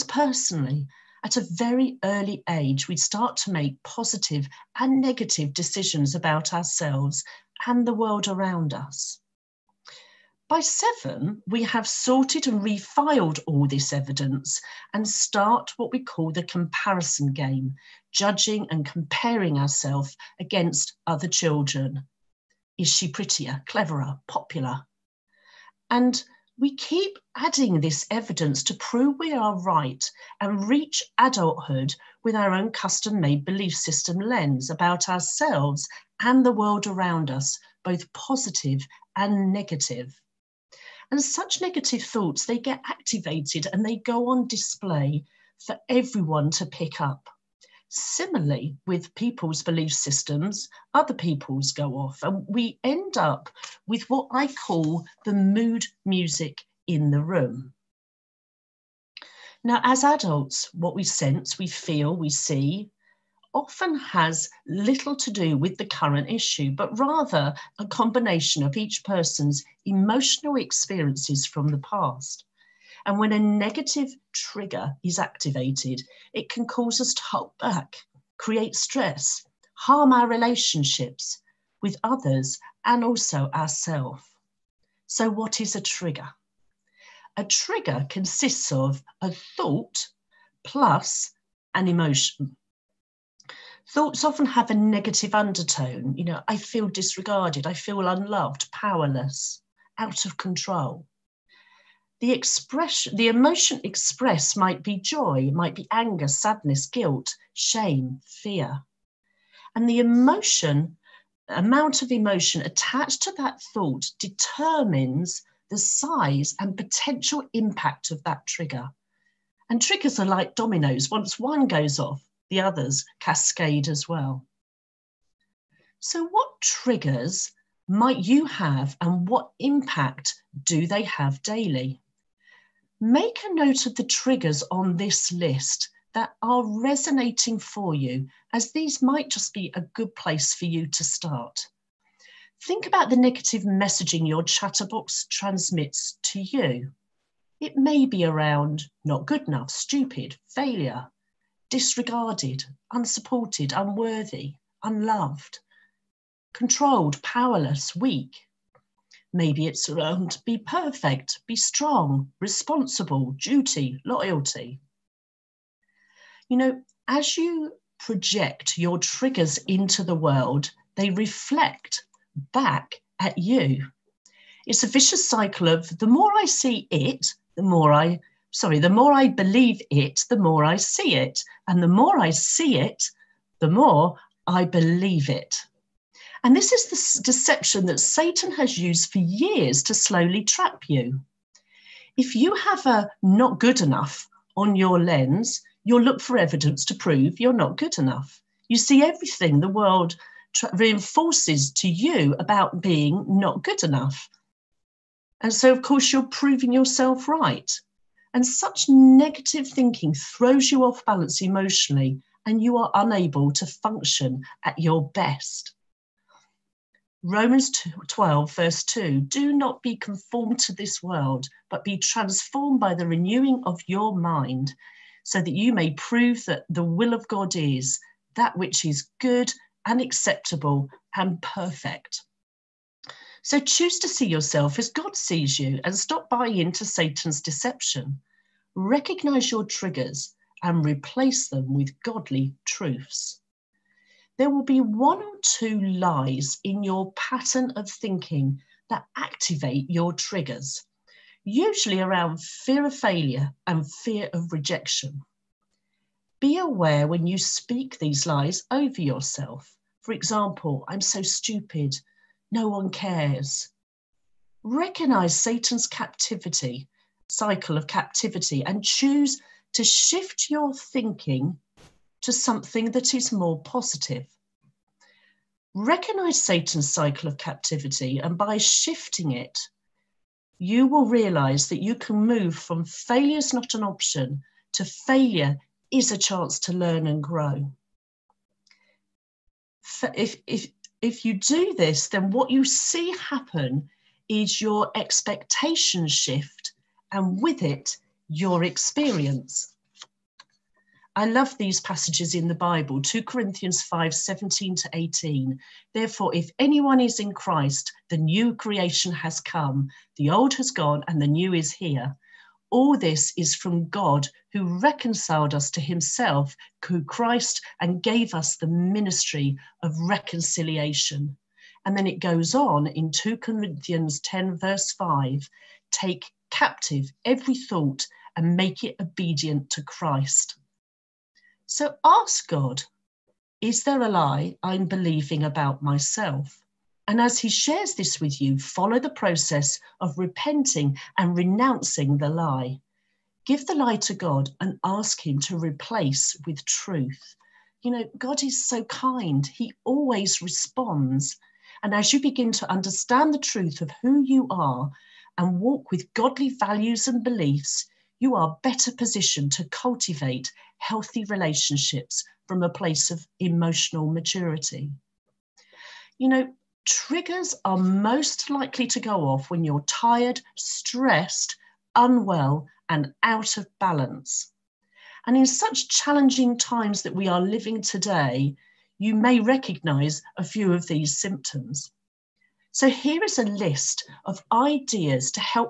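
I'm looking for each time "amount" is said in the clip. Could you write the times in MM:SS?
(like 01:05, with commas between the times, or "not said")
01:51.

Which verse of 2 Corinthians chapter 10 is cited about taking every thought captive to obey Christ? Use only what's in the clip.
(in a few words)
verse 5.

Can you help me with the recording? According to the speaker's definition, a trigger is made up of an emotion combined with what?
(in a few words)
a thought.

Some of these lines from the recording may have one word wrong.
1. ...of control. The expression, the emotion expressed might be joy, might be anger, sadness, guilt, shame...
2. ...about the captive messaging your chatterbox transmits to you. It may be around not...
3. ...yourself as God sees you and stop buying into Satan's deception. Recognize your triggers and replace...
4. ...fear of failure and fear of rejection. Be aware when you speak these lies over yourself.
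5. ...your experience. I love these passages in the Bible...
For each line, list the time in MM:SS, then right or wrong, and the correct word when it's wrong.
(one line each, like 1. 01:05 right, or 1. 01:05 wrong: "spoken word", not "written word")
1. 01:40 right
2. 02:22 wrong: "negative", not "captive"
3. 03:54 right
4. 04:12 right
5. 04:58 right.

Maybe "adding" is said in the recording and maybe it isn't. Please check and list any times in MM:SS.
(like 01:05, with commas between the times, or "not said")
00:27.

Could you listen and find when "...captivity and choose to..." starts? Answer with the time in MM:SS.
04:27.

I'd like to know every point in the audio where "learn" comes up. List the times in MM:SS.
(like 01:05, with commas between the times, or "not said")
04:46.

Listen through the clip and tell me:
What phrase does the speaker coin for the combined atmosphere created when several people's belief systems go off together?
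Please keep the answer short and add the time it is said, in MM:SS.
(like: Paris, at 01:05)
the mood music in the room, at 00:55.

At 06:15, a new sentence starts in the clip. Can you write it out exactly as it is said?
And in such challenging times that we are living today, you may recognize a few of these symptoms.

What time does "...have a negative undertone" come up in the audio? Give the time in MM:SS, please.
01:34.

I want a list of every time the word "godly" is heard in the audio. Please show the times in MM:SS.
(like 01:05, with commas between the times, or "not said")
04:02, 05:56.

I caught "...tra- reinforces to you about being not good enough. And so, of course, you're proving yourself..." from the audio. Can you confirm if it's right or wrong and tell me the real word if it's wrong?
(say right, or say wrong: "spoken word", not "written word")
right.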